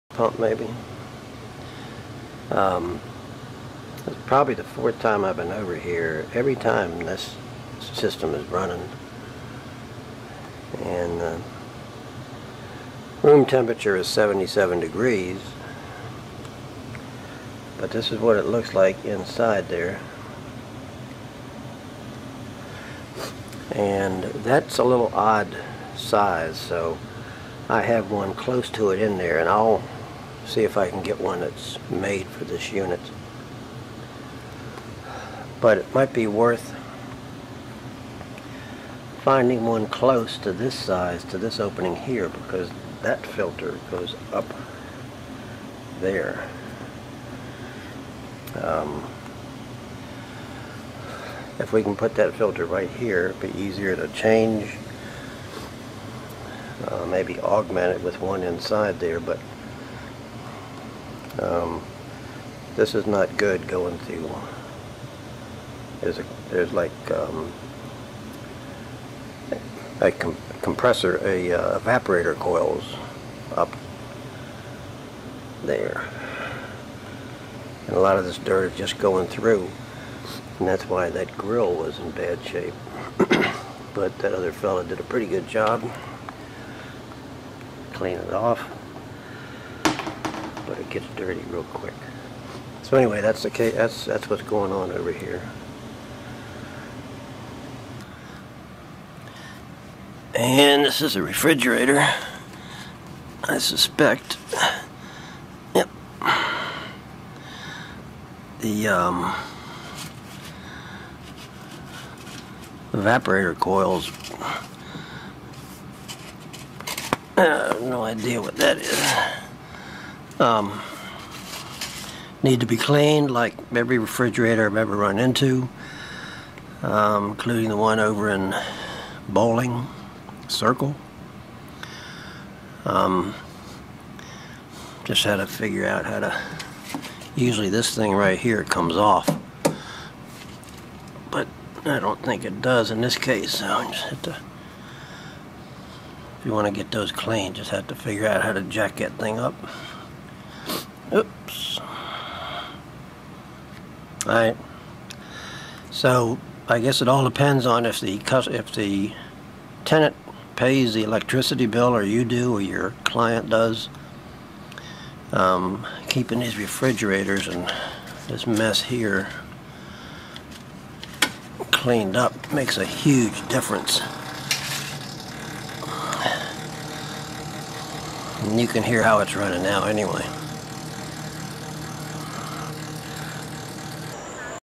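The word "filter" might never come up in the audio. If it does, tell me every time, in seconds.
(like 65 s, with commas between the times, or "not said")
43 s, 52 s.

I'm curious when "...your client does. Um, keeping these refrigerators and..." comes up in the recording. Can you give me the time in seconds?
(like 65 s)
162 s.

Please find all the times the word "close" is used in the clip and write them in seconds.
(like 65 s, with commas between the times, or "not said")
28 s, 39 s.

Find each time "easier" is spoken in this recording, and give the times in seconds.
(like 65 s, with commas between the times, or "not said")
53 s.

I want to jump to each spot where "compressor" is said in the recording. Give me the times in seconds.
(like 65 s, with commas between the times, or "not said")
70 s.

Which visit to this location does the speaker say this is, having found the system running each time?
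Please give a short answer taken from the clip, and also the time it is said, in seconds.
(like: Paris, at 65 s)
fourth, at 4 s.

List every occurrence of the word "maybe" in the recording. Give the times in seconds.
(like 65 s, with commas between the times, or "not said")
0 s, 57 s.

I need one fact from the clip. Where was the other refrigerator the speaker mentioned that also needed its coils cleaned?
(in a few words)
Bowling Circle.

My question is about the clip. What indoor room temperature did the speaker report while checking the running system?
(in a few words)
77 degrees.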